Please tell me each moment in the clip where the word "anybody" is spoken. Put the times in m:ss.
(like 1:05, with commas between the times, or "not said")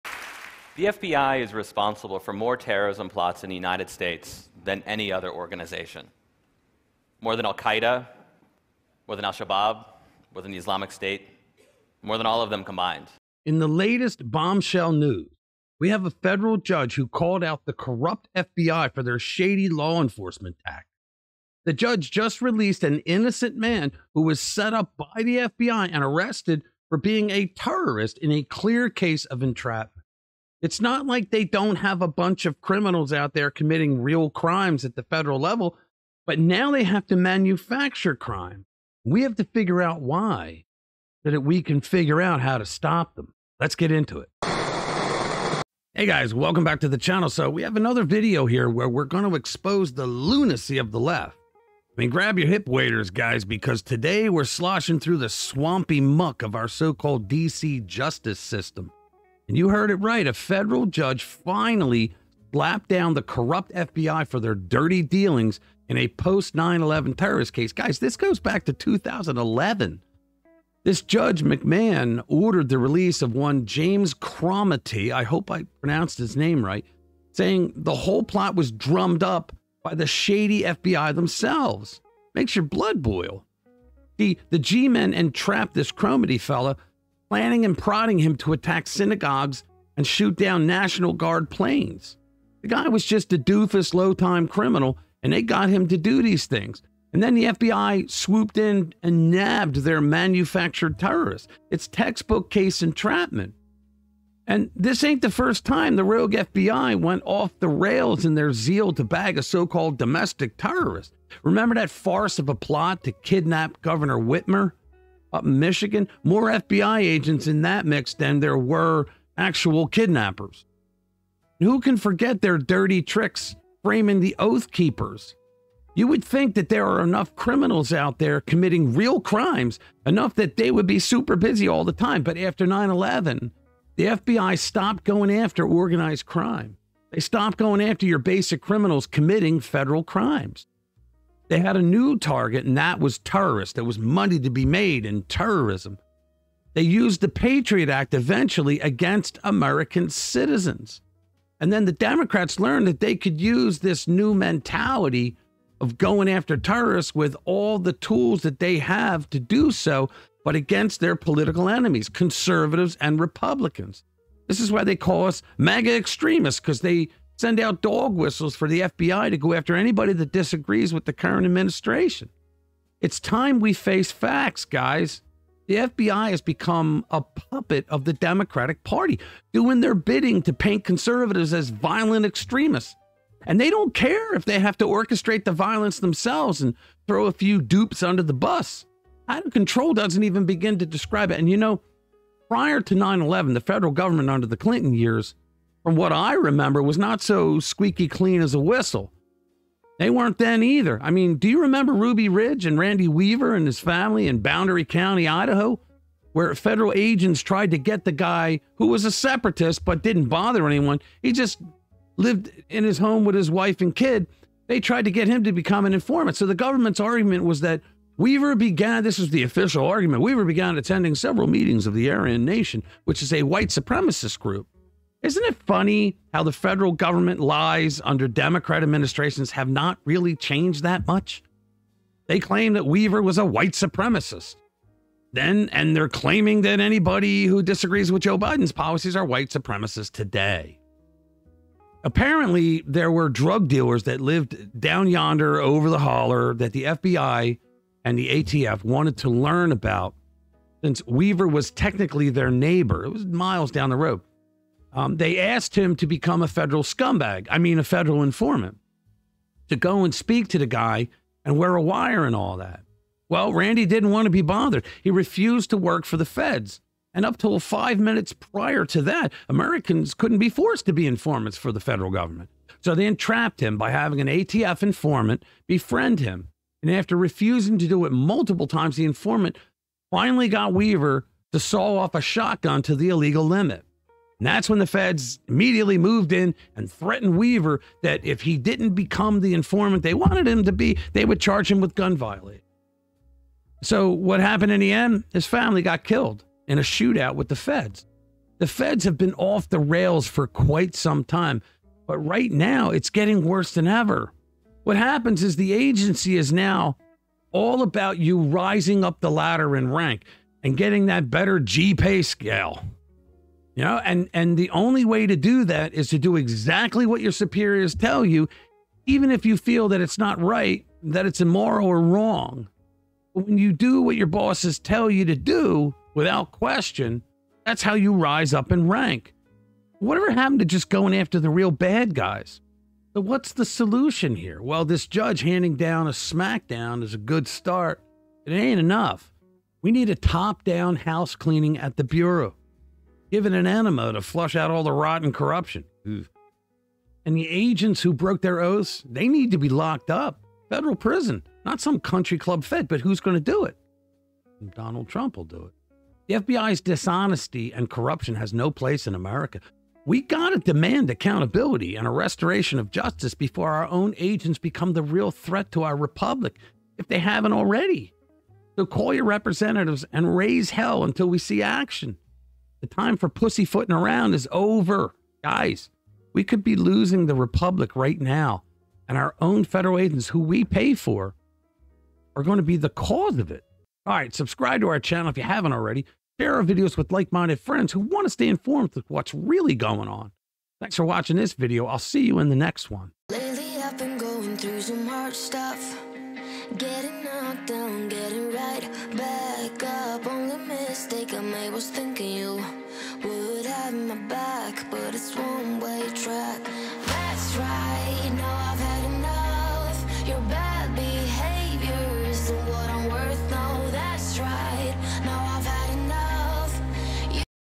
2:49, 3:56.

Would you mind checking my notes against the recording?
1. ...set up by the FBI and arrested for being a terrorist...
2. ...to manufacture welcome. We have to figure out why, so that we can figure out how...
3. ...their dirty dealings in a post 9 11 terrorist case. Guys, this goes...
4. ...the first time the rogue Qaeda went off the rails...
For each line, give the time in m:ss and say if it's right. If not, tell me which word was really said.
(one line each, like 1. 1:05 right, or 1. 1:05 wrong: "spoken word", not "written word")
1. 0:24 right
2. 0:37 wrong: "crime", not "welcome"
3. 1:04 right
4. 1:45 wrong: "FBI", not "Qaeda".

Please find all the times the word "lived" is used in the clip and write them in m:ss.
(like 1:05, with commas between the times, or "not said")
3:32, 4:04.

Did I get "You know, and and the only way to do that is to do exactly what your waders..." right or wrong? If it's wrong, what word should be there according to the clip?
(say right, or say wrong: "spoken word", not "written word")
wrong: "superiors", not "waders".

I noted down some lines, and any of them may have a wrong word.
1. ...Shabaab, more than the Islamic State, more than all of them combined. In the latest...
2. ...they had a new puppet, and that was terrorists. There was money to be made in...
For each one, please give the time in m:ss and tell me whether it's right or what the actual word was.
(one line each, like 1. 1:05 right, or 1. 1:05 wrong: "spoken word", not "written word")
1. 0:09 right
2. 2:21 wrong: "target", not "puppet".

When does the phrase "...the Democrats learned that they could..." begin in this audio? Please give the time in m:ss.
2:31.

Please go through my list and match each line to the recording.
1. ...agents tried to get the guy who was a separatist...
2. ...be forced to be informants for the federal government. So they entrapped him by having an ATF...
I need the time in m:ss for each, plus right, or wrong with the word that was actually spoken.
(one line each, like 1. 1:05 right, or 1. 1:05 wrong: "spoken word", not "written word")
1. 3:26 right
2. 4:30 right.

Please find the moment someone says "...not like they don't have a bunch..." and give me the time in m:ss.
0:30.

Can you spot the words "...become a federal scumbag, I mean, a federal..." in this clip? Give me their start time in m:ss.
4:16.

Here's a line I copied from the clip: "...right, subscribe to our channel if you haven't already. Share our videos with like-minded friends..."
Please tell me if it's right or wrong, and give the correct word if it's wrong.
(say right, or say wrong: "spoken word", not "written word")
right.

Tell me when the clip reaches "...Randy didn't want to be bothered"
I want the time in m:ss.
4:23.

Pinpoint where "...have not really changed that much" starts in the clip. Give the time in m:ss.
3:49.